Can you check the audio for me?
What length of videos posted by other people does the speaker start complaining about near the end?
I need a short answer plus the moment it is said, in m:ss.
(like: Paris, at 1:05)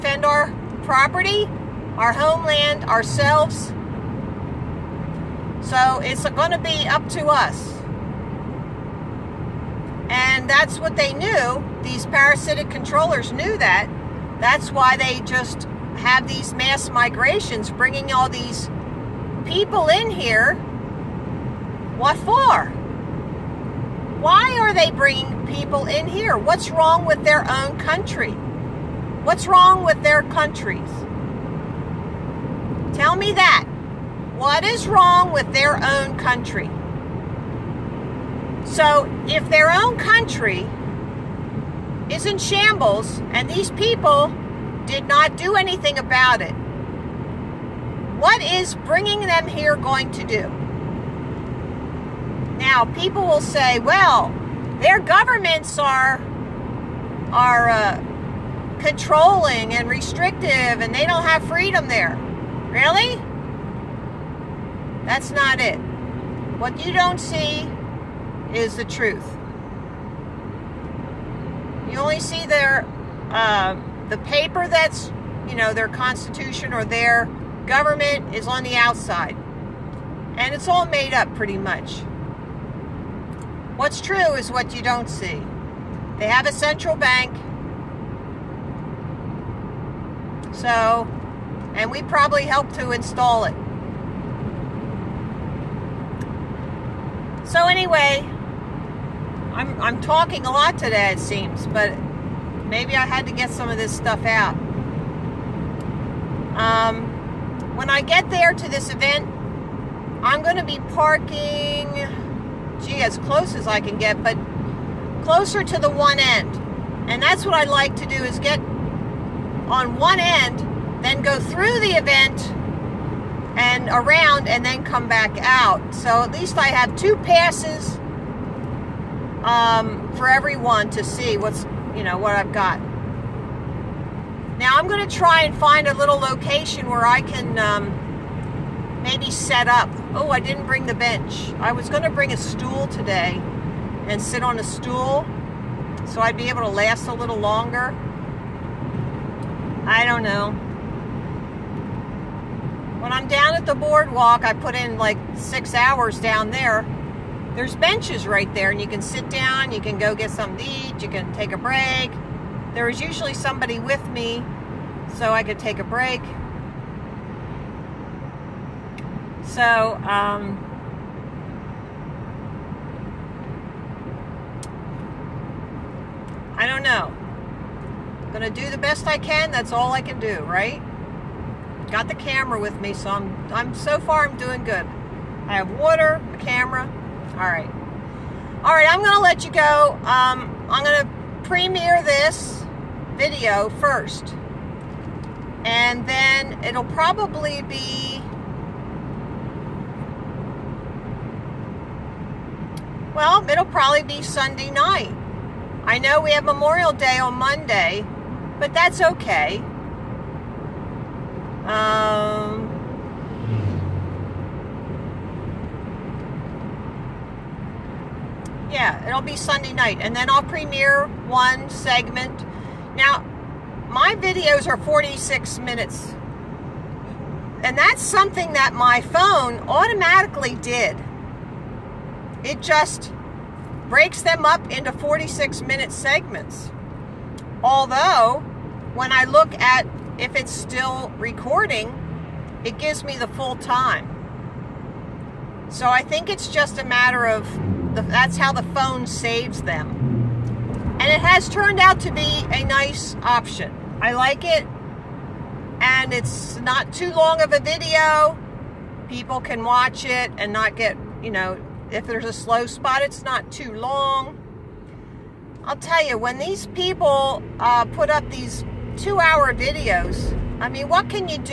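2 hours, at 4:28.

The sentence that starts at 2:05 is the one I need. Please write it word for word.
So at least I have two passes um, for everyone to see what's you know, what I've got.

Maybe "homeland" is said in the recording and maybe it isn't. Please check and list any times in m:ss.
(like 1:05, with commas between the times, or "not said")
0:02.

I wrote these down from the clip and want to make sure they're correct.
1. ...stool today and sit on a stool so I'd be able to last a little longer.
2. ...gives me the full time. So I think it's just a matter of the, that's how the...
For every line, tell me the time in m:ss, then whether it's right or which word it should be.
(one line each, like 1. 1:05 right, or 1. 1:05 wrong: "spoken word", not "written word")
1. 2:22 right
2. 4:02 right.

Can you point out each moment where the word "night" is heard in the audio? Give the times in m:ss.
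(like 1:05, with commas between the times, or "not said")
3:24, 3:39.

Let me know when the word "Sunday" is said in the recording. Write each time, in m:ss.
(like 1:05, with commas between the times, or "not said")
3:24, 3:39.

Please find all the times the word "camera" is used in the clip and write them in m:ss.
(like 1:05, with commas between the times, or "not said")
3:02, 3:06.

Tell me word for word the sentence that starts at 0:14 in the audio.
That's why they just have these mass migrations, bringing all these people in here, what for?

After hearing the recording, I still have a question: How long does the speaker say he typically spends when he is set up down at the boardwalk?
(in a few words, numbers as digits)
6 hours.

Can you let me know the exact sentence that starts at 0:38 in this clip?
So, if their own country is in shambles and these people did not do anything about it.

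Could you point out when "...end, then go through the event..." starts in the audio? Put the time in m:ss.
2:00.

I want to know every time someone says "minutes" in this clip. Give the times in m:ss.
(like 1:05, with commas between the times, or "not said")
3:45, 3:55.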